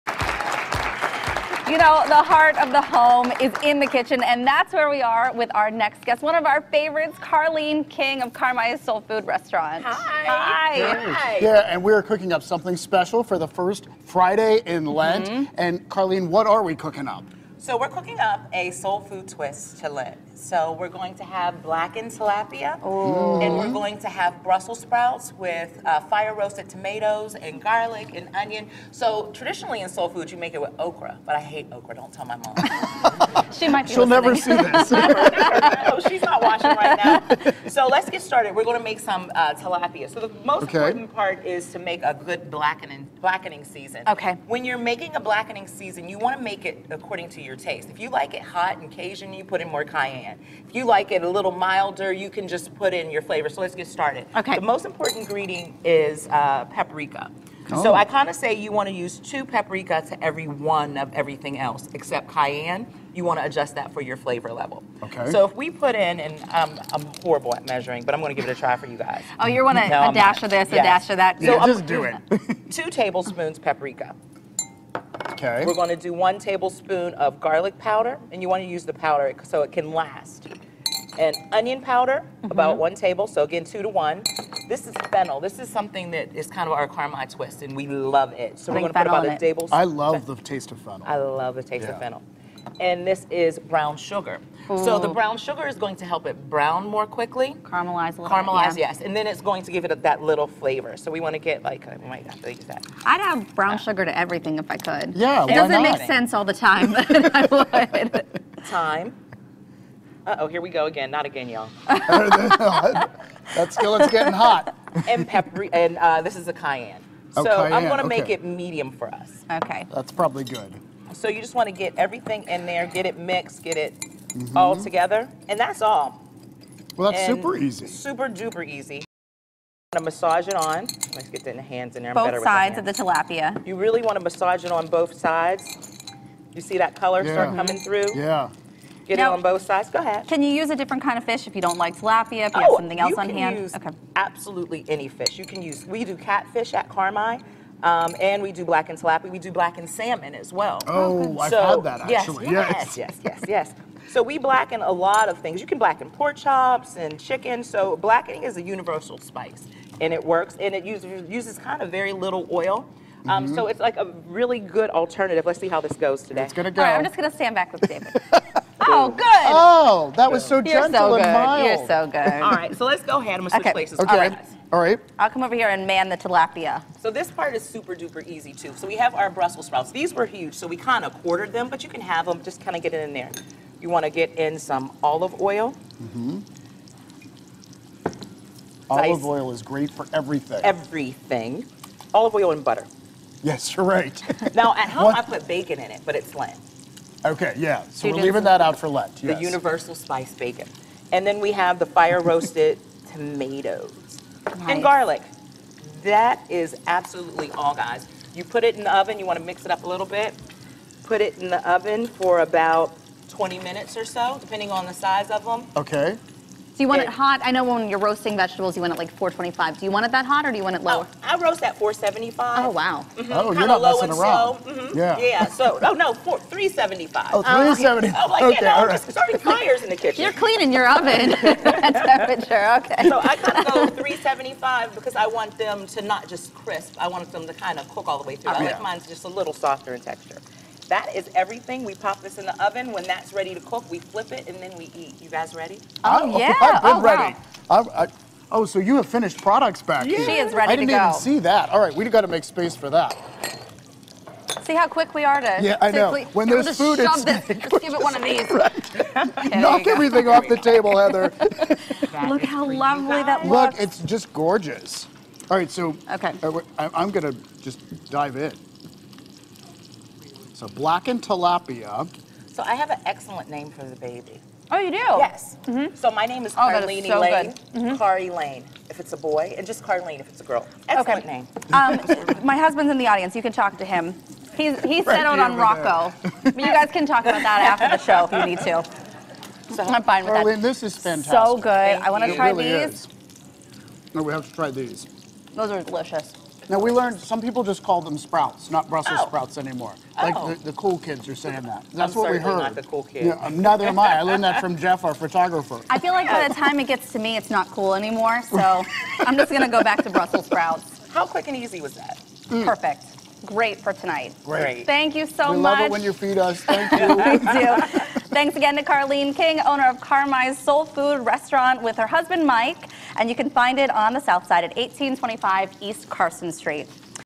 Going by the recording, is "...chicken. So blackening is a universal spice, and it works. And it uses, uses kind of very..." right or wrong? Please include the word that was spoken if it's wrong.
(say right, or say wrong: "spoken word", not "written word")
right.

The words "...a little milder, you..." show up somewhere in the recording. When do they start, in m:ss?
0:51.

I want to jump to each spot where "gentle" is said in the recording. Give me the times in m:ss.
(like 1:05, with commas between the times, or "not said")
2:50.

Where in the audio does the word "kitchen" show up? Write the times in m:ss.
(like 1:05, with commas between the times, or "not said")
0:03, 3:50.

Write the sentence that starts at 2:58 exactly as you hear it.
So we have our Brussels sprouts.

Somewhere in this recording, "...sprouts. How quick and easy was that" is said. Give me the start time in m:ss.
5:10.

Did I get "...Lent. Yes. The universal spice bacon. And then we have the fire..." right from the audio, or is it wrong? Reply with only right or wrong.
right.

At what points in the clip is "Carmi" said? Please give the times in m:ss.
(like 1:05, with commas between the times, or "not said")
0:08, 1:26, 2:26, 5:19.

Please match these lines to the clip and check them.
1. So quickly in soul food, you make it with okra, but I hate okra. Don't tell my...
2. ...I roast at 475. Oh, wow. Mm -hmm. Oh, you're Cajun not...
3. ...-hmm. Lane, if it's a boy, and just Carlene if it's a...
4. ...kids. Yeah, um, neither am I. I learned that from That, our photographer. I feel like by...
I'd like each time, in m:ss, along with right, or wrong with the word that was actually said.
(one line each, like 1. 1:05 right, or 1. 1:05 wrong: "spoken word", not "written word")
1. 0:28 wrong: "traditionally", not "quickly"
2. 3:41 wrong: "Kinda", not "Cajun"
3. 4:37 right
4. 5:03 wrong: "Jeff", not "That".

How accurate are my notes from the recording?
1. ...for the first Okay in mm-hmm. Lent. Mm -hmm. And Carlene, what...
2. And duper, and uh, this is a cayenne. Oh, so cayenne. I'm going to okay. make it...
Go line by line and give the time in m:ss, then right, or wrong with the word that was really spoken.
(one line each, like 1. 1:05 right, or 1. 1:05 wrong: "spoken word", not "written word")
1. 0:13 wrong: "Friday", not "Okay"
2. 1:55 wrong: "pepper", not "duper".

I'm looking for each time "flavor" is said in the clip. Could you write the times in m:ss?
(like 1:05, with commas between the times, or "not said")
0:53, 1:04, 1:40.